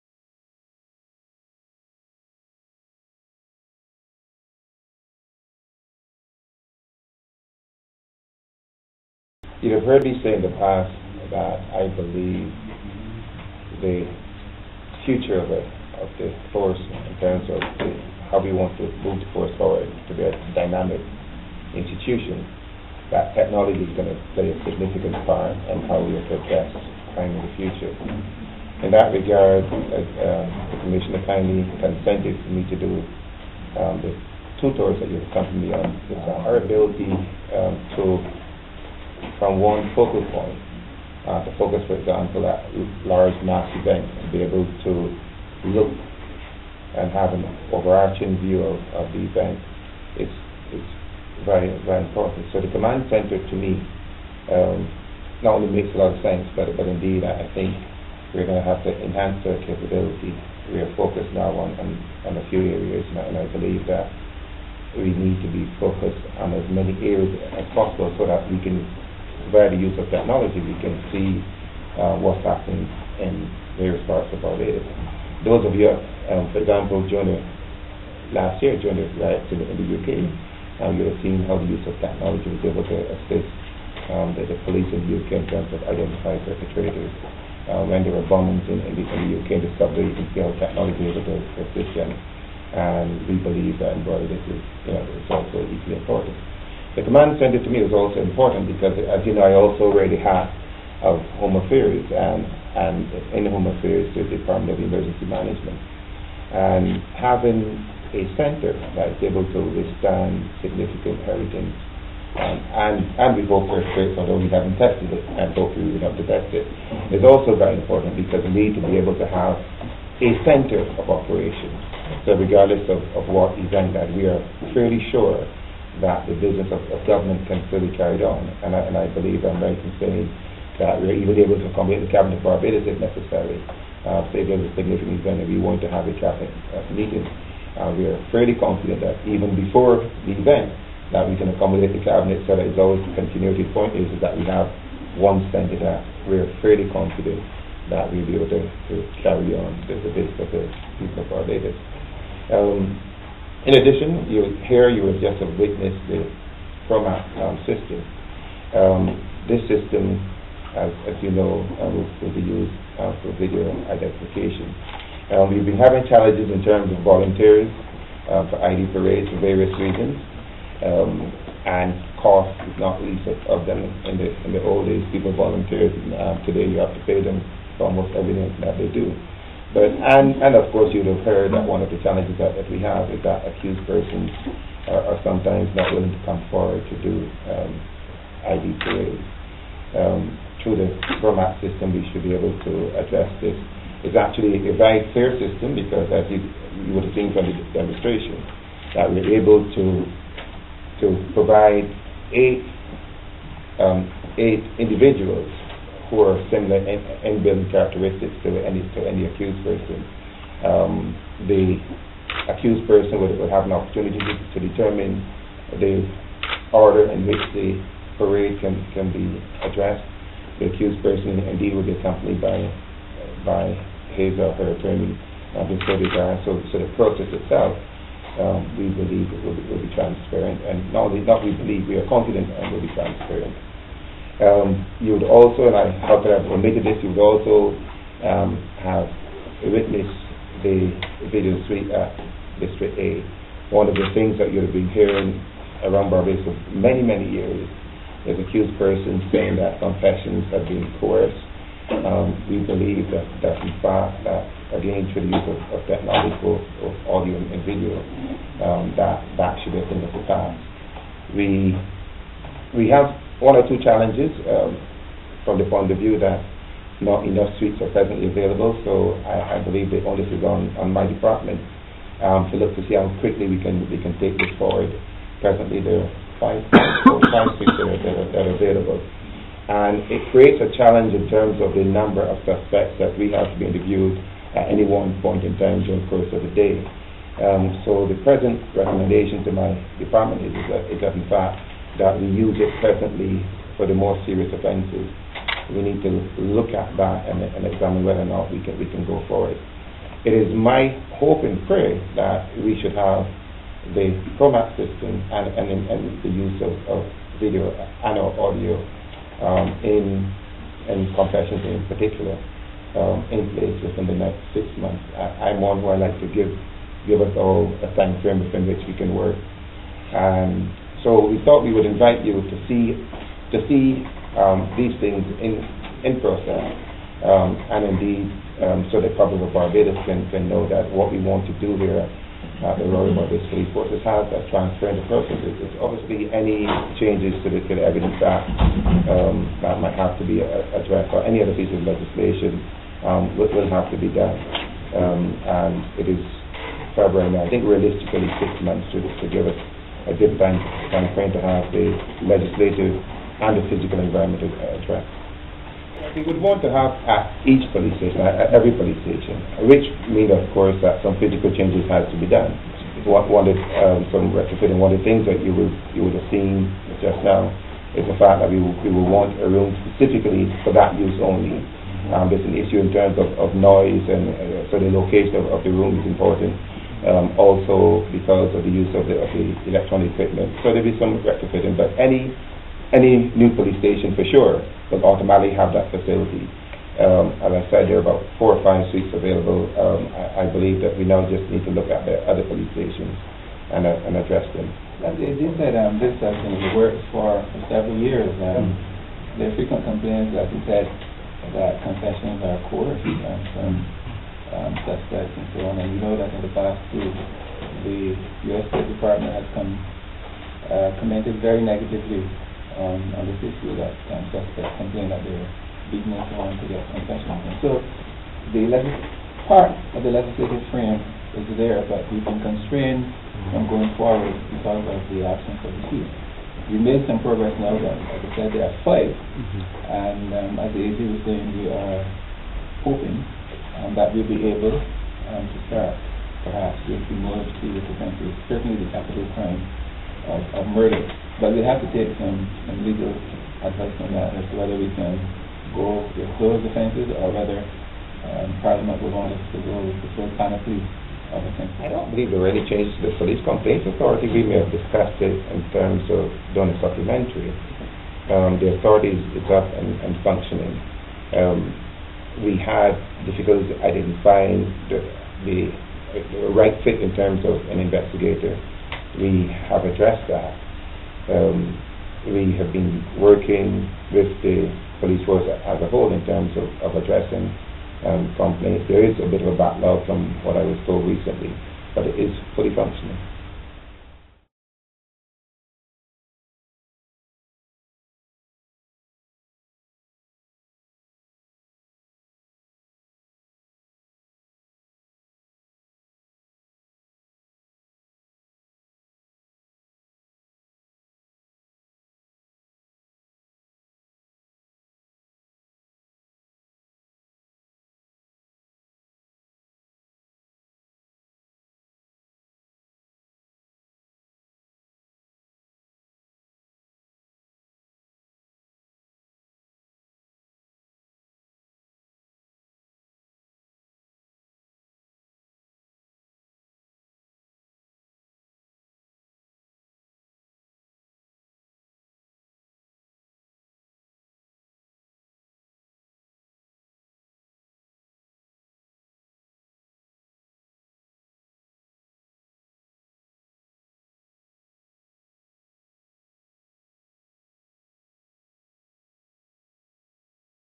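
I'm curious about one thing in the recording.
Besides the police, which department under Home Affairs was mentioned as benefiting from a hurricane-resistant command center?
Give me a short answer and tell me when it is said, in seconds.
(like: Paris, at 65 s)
Department of Emergency Management, at 104 s.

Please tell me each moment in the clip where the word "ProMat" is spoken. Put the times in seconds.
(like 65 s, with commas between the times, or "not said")
156 s, 191 s, 304 s.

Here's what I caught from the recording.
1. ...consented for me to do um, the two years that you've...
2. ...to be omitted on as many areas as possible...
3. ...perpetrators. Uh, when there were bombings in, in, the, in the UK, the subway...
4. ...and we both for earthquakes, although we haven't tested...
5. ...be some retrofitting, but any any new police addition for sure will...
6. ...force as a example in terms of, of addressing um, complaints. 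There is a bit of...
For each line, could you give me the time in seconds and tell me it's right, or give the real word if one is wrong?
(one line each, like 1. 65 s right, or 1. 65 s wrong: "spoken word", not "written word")
1. 31 s wrong: "tours", not "years"
2. 65 s wrong: "focused", not "omitted"
3. 86 s right
4. 113 s right
5. 380 s wrong: "station", not "addition"
6. 475 s wrong: "whole", not "example".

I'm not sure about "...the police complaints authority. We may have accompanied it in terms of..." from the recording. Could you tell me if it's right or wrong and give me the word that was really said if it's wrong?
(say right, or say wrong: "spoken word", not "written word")
wrong: "discussed", not "accompanied".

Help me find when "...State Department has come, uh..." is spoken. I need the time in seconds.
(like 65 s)
408 s.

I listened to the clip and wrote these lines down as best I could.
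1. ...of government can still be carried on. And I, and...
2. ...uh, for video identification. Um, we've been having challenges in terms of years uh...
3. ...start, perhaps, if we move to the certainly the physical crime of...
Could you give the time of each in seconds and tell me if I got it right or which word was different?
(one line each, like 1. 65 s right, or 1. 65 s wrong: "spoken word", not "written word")
1. 126 s right
2. 162 s wrong: "volunteers", not "years"
3. 435 s wrong: "capital", not "physical".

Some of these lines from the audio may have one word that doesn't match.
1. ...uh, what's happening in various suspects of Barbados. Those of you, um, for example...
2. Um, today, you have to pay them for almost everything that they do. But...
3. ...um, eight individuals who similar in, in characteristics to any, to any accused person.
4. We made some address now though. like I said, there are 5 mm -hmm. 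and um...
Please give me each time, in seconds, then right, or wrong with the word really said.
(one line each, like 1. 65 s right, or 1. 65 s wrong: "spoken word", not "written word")
1. 71 s wrong: "parts", not "suspects"
2. 176 s right
3. 203 s right
4. 426 s wrong: "progress", not "address".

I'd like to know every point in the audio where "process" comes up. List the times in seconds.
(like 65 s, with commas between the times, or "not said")
226 s, 335 s.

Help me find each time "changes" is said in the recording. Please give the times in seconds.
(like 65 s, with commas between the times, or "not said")
337 s, 361 s, 452 s.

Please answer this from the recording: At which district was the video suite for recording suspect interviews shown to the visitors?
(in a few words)
District A.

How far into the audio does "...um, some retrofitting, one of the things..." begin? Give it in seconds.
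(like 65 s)
363 s.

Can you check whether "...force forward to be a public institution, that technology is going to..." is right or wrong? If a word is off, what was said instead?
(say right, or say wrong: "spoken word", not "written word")
wrong: "dynamic", not "public".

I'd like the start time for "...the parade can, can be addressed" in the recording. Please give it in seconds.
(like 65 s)
217 s.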